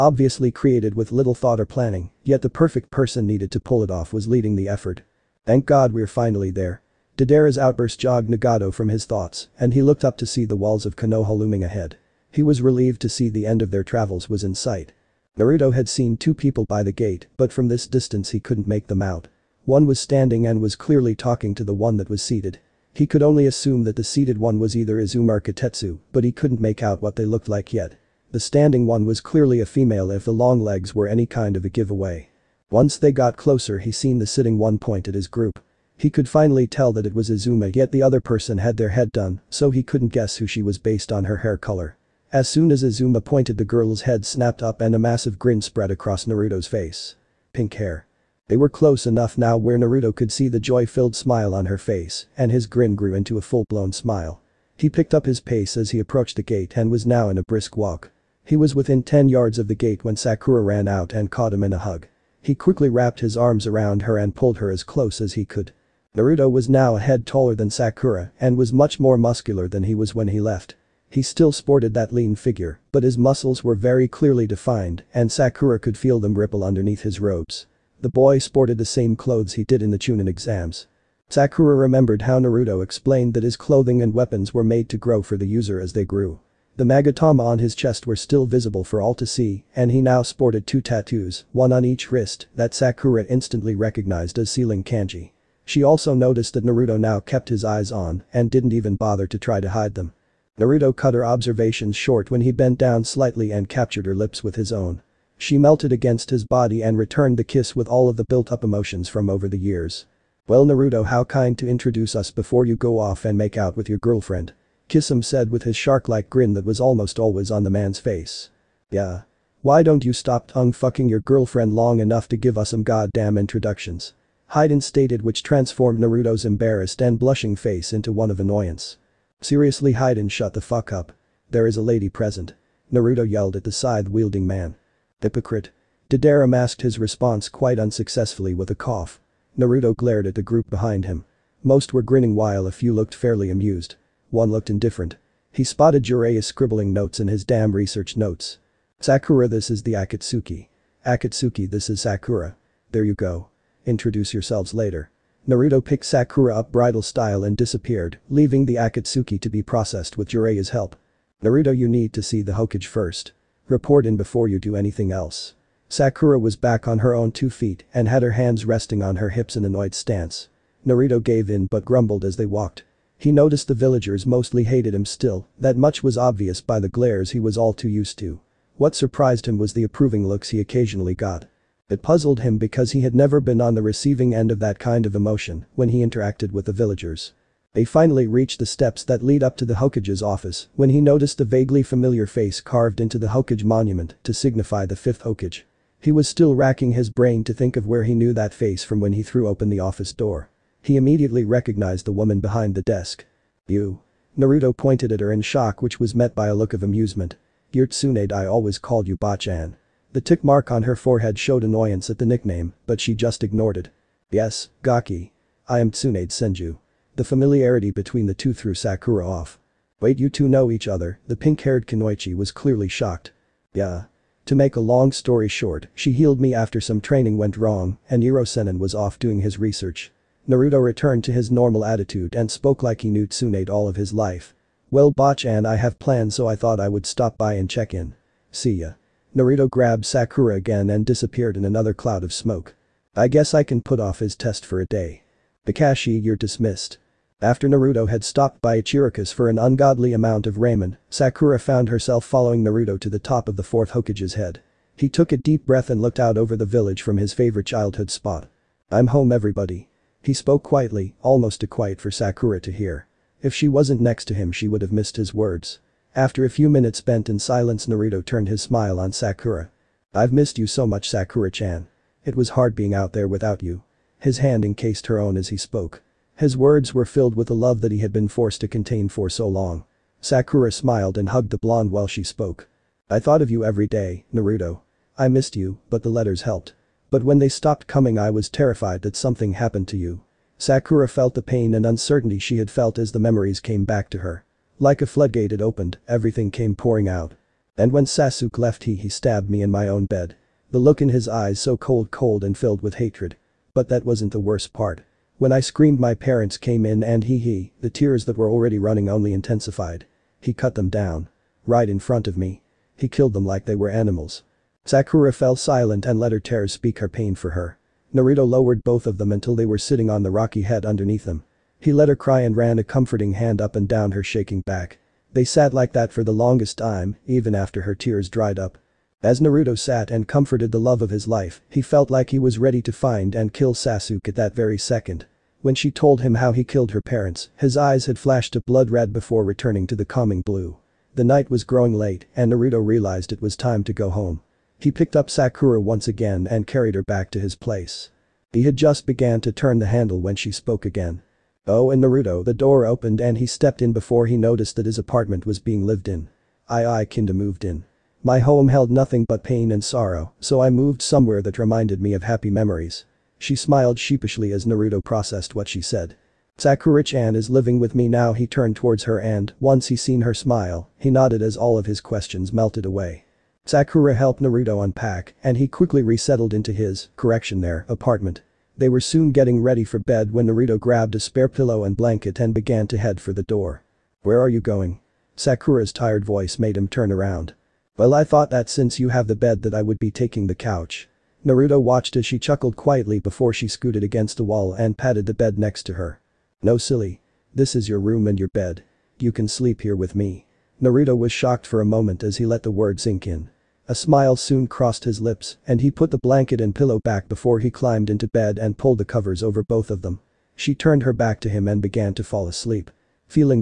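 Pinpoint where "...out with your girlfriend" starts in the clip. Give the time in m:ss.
1:53.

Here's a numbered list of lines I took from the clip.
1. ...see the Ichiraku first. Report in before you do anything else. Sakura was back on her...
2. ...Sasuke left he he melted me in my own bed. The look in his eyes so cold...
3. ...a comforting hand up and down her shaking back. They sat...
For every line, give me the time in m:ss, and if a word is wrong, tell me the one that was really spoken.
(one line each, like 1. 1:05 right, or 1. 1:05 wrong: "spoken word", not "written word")
1. 2:42 wrong: "Hokage", not "Ichiraku"
2. 4:58 wrong: "stabbed", not "melted"
3. 5:22 right.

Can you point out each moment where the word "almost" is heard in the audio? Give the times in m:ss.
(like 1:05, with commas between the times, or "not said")
1:56, 4:21.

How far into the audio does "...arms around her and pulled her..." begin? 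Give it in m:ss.
1:03.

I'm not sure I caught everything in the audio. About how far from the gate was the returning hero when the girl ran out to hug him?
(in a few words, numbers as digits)
10 yards.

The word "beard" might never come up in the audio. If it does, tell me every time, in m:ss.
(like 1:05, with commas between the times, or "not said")
not said.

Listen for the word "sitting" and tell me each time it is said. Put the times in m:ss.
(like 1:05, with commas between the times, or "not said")
0:34, 5:19.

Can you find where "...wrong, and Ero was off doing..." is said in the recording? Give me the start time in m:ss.
3:47.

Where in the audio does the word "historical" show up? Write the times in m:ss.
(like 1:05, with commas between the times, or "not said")
not said.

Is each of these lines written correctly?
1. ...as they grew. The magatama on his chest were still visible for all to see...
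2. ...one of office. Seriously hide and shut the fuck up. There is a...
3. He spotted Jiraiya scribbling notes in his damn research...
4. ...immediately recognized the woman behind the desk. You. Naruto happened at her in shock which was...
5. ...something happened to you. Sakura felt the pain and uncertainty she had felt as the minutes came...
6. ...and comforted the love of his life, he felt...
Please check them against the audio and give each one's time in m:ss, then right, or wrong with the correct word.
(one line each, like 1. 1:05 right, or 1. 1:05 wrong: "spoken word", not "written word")
1. 1:25 right
2. 2:08 wrong: "annoyance", not "office"
3. 2:25 right
4. 3:20 wrong: "pointed", not "happened"
5. 4:49 wrong: "memories", not "minutes"
6. 5:30 right.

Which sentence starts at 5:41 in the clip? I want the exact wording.
The night was growing late and Naruto realized it was time to go home.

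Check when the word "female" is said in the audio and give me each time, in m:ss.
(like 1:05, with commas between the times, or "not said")
0:29.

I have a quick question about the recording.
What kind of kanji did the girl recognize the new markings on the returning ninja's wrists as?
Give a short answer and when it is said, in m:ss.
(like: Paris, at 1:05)
Sealing kanji, at 1:34.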